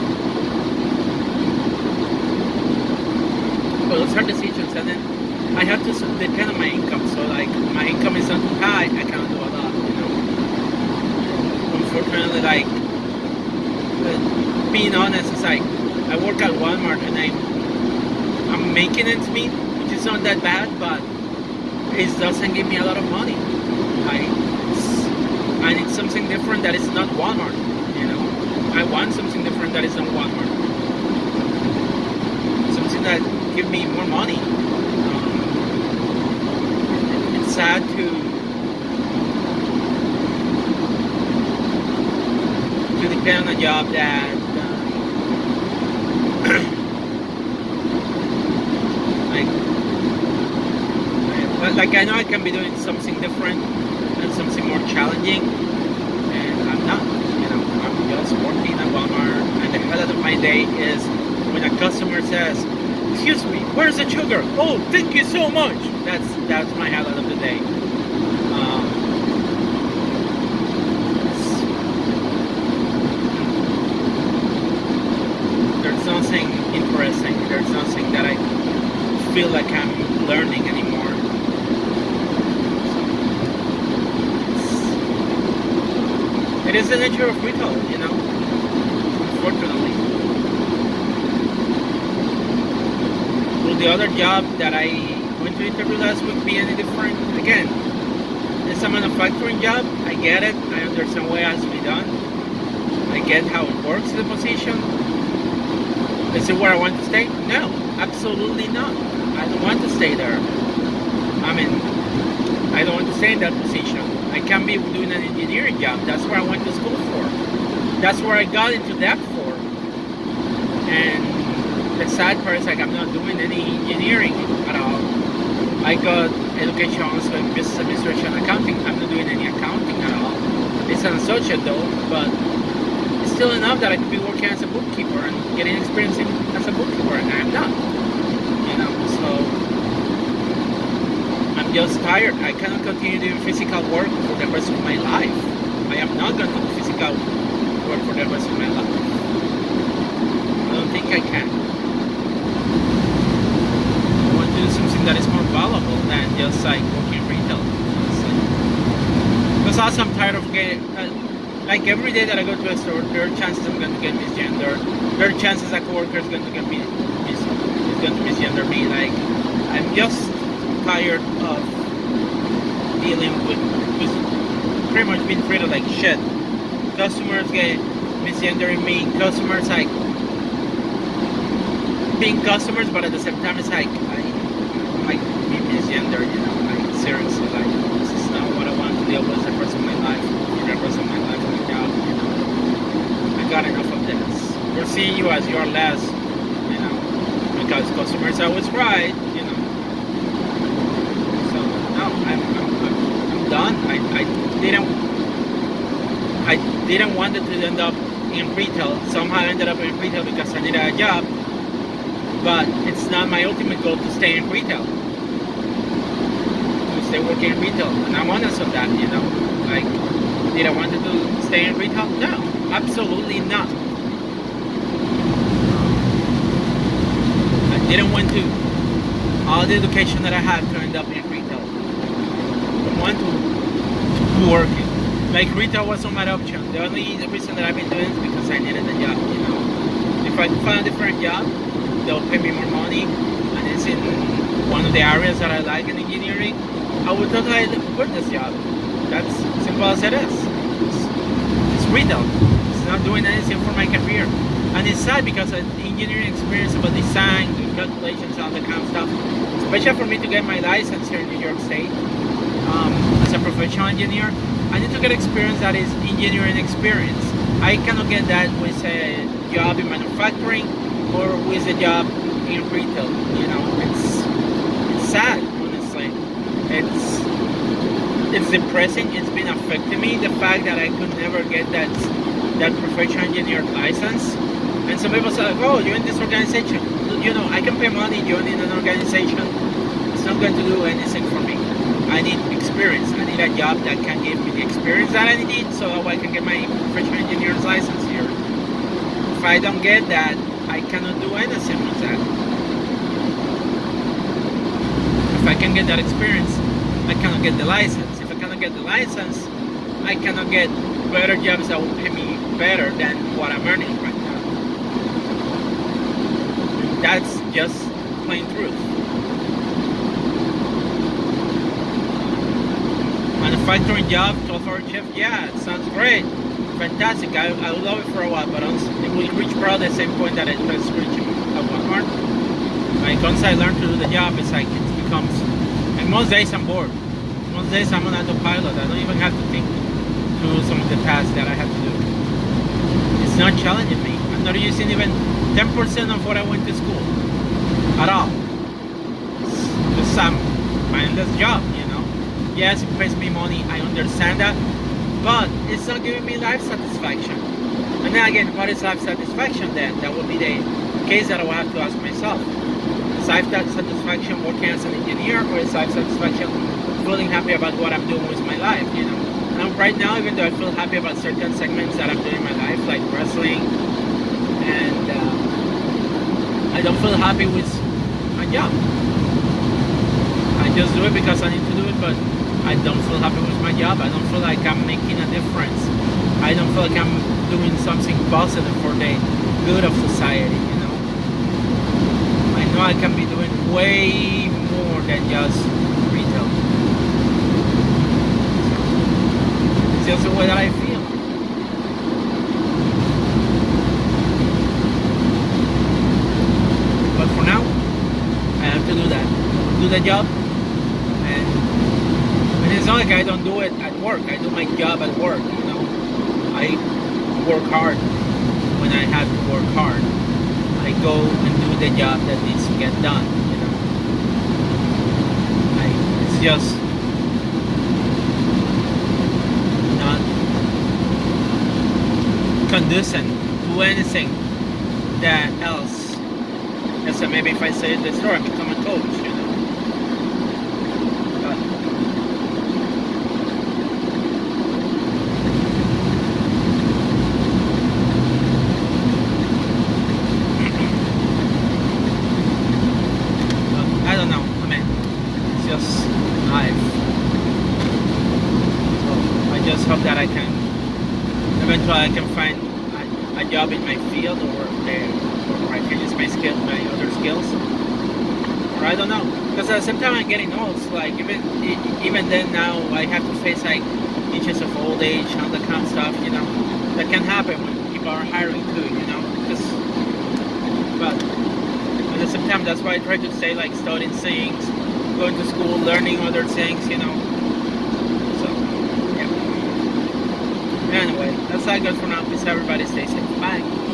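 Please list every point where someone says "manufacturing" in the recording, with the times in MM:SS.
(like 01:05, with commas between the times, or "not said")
01:38, 04:29, 05:23.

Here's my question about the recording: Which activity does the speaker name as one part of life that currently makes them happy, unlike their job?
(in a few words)
wrestling.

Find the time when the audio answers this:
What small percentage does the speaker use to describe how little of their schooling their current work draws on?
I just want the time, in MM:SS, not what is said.
05:45.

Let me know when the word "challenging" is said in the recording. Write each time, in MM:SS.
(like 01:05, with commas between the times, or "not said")
00:54, 05:43.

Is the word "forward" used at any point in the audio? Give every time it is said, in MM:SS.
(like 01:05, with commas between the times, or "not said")
not said.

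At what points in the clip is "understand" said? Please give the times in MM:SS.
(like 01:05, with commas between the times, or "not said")
01:40, 05:53.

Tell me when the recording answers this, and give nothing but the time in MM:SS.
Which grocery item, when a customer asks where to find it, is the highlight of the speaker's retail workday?
01:03.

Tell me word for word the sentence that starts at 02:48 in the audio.
Like I'm just tired of dealing with, pretty much being treated like shit.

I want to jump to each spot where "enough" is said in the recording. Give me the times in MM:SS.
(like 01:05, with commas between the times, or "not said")
02:13, 03:13.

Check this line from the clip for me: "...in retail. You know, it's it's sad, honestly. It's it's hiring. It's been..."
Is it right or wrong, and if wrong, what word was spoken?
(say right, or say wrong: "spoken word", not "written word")
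wrong: "depressing", not "hiring".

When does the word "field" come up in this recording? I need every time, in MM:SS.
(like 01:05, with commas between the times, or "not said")
07:44.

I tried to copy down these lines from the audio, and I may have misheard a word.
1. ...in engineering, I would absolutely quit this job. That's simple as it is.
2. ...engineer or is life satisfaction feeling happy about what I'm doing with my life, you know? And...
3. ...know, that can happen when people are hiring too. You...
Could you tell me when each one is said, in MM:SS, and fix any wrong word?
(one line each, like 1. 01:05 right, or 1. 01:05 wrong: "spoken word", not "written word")
1. 04:05 wrong: "totally", not "absolutely"
2. 06:04 right
3. 07:56 right.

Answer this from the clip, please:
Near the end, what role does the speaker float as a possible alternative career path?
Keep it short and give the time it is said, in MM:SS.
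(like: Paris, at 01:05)
coach, at 07:18.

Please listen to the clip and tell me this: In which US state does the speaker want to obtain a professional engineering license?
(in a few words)
New York.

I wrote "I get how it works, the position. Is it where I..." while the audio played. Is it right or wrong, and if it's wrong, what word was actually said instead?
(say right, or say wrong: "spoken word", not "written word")
right.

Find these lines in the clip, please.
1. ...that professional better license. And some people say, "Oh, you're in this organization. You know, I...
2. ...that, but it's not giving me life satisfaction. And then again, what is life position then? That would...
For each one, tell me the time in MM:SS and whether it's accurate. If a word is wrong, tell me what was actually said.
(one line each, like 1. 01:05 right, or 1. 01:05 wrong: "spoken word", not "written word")
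1. 04:42 wrong: "engineer", not "better"
2. 05:54 wrong: "satisfaction", not "position".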